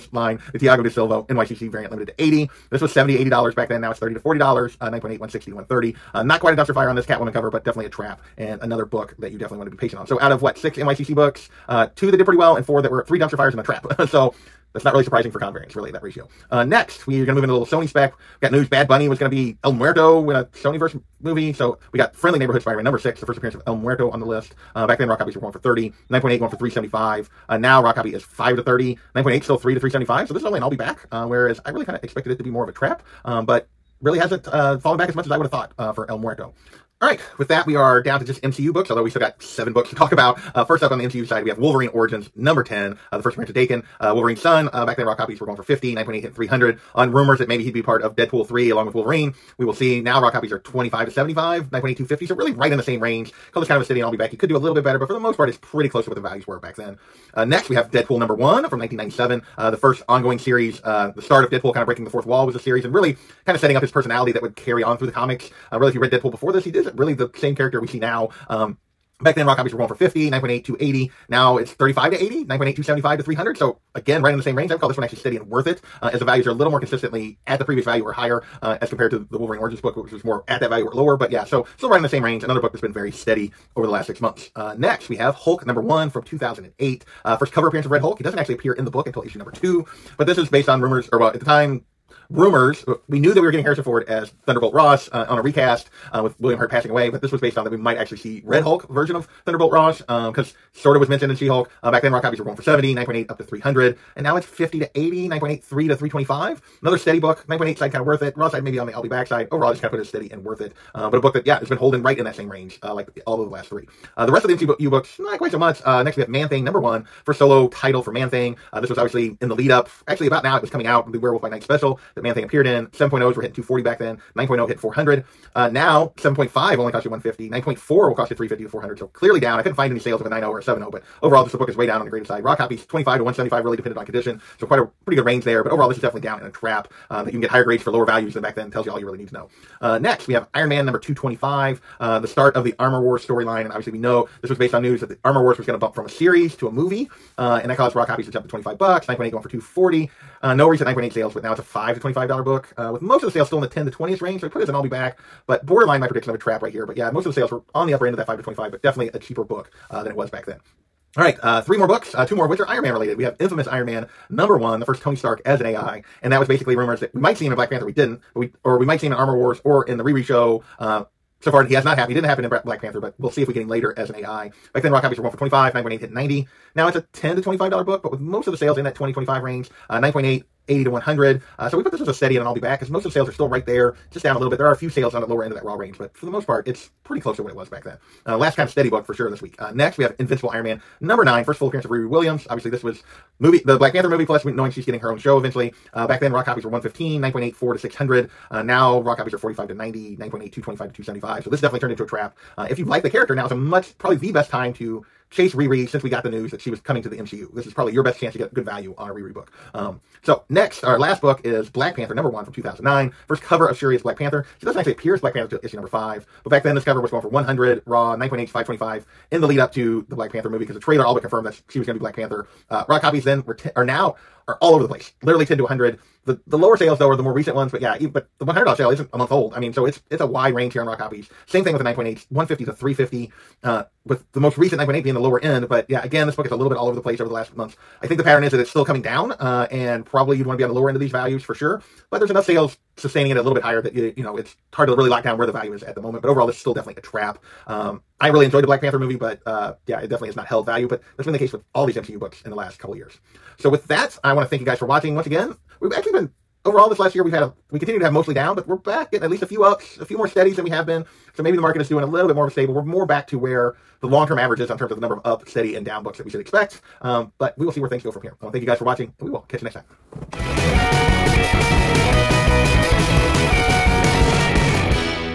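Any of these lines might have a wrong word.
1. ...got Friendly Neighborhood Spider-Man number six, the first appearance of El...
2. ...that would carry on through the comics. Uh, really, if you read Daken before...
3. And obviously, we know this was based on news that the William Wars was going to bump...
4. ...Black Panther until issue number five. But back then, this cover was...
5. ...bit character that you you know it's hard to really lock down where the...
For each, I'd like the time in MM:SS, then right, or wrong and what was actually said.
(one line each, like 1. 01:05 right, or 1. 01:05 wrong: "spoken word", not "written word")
1. 00:21 right
2. 01:04 wrong: "Deadpool", not "Daken"
3. 02:23 wrong: "Armor", not "William"
4. 03:35 right
5. 04:03 wrong: "higher", not "character".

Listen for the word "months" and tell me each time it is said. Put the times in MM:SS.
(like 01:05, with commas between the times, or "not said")
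01:24, 03:49, 03:57.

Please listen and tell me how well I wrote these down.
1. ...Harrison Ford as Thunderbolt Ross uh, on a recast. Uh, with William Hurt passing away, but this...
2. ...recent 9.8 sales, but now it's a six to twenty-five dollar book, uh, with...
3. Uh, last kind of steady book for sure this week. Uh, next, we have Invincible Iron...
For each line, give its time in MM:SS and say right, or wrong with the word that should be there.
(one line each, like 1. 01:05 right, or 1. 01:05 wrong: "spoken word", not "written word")
1. 01:33 right
2. 02:30 wrong: "five", not "six"
3. 03:08 right.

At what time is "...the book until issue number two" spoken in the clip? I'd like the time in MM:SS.
01:28.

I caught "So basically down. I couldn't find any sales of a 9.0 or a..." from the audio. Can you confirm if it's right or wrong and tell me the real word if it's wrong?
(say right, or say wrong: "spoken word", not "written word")
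wrong: "clearly", not "basically".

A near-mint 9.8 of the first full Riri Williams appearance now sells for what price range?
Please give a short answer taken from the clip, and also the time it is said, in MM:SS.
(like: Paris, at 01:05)
$225 to $275, at 03:20.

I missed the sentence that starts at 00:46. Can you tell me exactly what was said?
On rumors that maybe he'd be part of Deadpool 3 along with Wolverine.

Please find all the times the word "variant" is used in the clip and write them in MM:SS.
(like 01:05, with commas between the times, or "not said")
00:01, 00:15.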